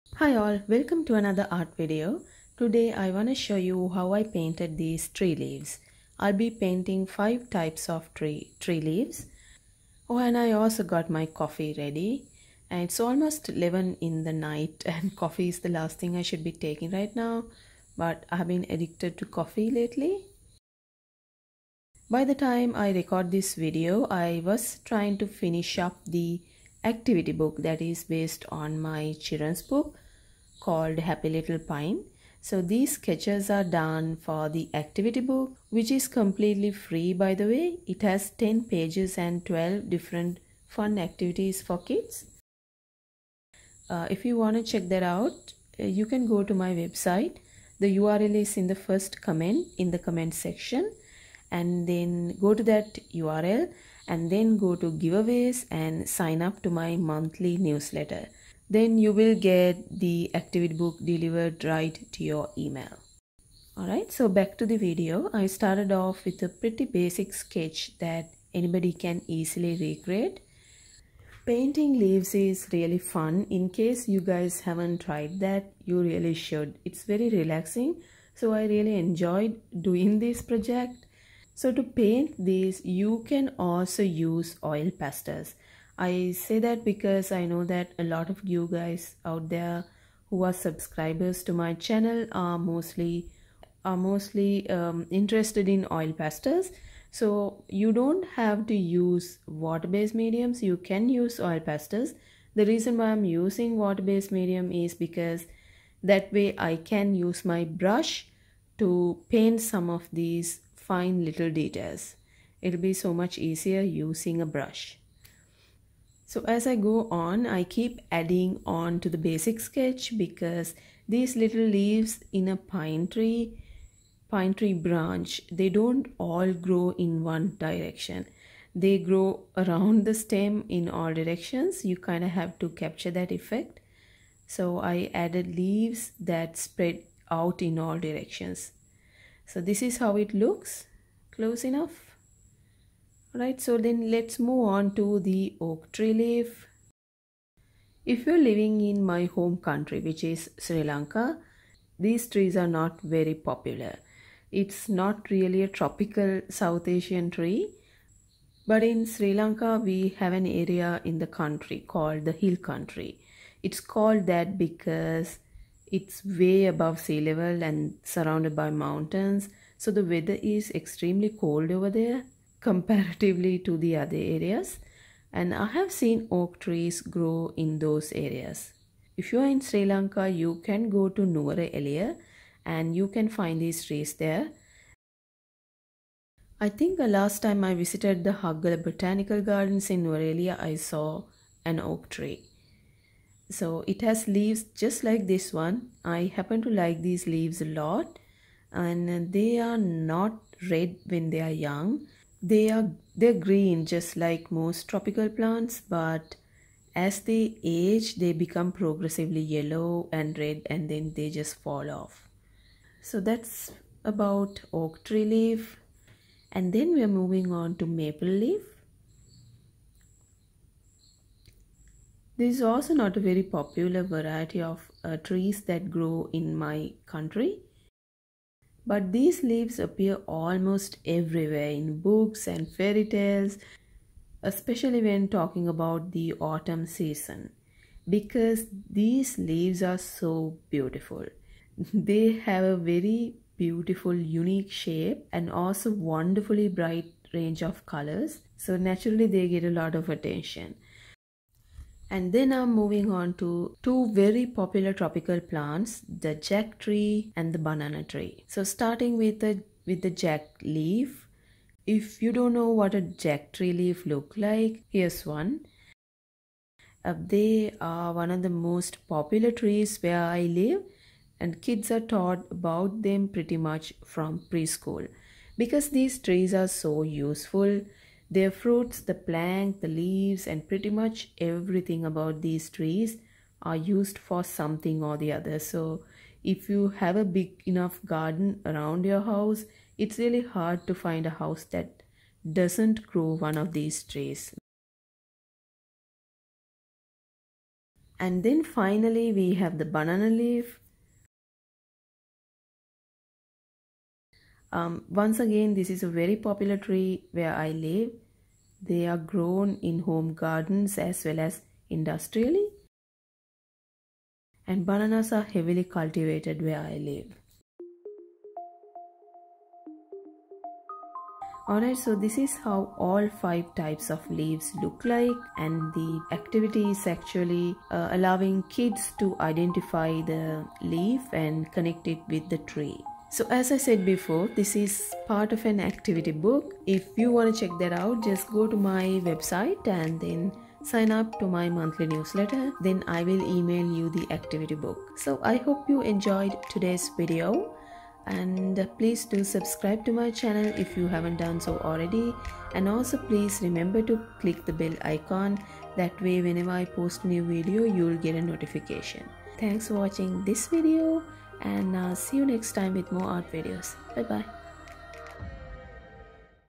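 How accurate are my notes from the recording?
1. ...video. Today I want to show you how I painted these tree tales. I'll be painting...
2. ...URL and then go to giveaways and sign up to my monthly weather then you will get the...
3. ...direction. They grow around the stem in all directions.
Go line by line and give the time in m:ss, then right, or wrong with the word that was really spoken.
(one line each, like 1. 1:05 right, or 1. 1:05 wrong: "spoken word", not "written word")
1. 0:01 wrong: "leaves", not "tales"
2. 0:53 wrong: "newsletter", not "weather"
3. 2:07 right.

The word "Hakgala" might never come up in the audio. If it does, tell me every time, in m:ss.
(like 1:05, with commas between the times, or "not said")
3:08.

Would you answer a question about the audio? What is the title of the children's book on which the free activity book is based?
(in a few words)
Happy Little Pine.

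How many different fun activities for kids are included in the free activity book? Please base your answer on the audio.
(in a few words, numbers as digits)
12.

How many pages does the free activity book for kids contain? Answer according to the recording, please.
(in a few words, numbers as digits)
10.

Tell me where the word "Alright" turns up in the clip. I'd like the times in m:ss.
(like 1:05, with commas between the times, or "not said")
1:03, 5:21.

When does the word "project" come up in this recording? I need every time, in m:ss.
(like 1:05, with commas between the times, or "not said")
1:20.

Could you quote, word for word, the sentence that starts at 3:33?
So that's about oak tree leaf.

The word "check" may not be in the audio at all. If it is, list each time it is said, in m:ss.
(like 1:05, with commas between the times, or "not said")
0:44, 5:37.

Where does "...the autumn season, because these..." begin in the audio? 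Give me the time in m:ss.
3:56.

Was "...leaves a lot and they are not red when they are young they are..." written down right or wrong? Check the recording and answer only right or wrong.
right.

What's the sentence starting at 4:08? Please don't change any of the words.
So naturally they get a lot of attention.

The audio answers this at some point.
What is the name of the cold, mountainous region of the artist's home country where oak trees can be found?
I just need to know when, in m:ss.
2:42.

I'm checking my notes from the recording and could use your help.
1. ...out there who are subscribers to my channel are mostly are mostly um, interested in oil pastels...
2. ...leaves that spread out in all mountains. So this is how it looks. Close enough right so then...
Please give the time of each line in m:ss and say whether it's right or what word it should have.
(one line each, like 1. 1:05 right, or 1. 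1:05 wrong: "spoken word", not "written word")
1. 1:29 right
2. 2:15 wrong: "directions", not "mountains".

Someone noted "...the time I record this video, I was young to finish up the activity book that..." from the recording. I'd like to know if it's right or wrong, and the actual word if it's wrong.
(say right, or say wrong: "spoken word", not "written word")
wrong: "trying", not "young".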